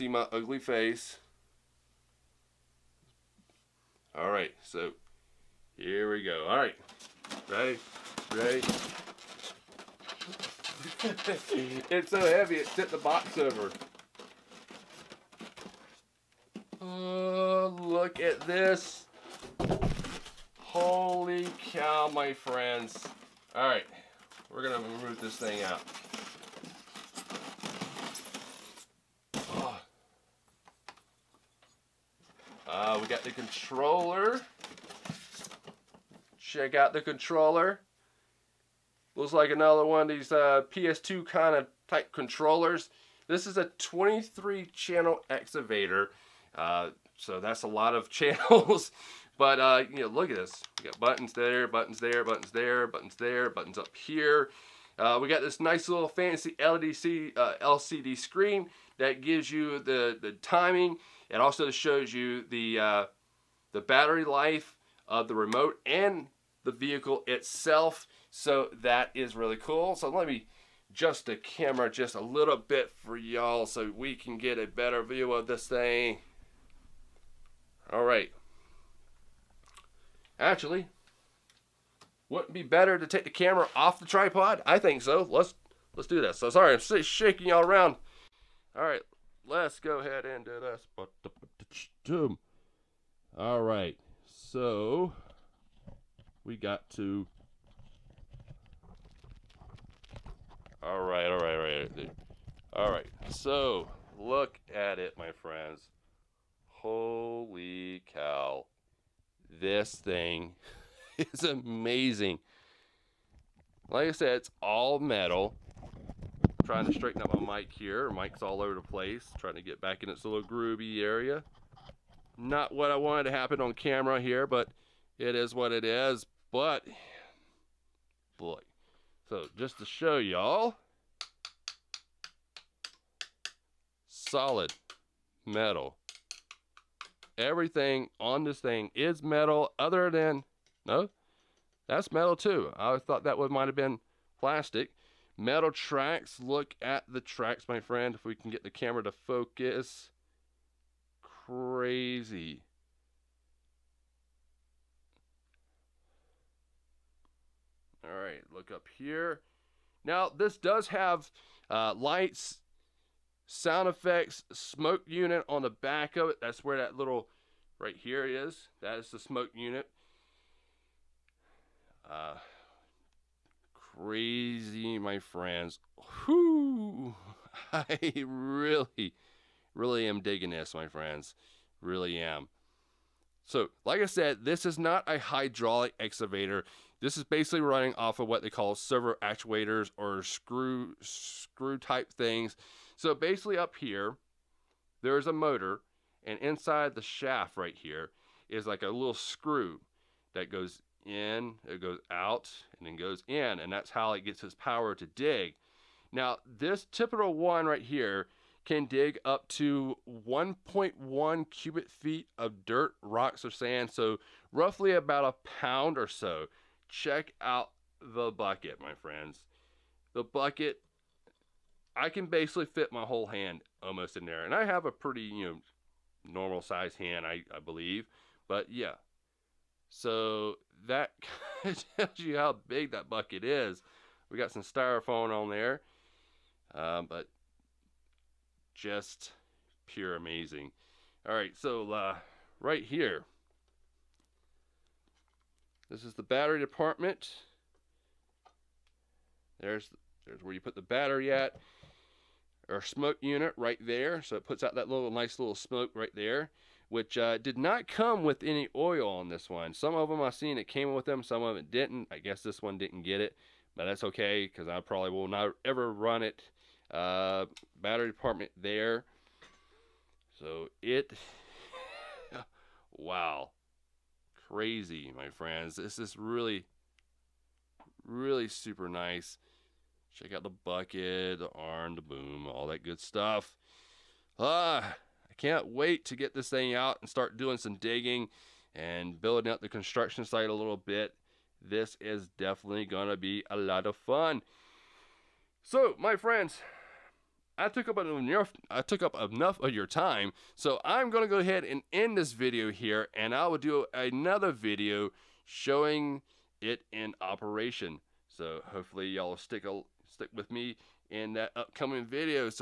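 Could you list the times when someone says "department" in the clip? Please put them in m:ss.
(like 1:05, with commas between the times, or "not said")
4:06, 4:28.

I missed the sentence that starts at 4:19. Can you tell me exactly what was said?
Some of them I've seen it came with them, some of it didn't.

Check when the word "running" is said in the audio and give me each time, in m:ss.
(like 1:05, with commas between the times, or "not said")
3:07.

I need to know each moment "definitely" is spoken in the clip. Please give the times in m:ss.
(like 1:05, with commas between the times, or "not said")
4:52.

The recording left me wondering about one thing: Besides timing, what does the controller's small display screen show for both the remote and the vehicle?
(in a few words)
battery life.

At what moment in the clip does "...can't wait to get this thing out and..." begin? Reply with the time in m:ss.
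4:45.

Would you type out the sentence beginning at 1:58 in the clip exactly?
Mic's all over the place, trying to get back in its little groovy area.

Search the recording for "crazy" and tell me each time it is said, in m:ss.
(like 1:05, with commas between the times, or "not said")
2:31, 2:53, 4:34.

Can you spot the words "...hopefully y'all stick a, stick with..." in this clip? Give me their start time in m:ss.
5:08.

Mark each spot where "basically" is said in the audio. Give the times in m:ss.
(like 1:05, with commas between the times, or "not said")
3:07, 3:13, 3:42.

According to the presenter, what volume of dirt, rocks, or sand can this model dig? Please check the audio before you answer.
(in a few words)
1.1 cubic feet.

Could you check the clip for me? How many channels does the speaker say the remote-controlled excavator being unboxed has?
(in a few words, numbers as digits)
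23.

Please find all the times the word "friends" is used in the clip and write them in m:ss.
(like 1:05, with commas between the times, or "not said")
0:22, 1:45, 2:27, 2:55, 3:00, 3:38, 4:35, 4:56.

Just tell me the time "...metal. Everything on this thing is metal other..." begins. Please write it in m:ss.
2:15.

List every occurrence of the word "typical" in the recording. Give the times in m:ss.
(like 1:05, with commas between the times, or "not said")
3:26.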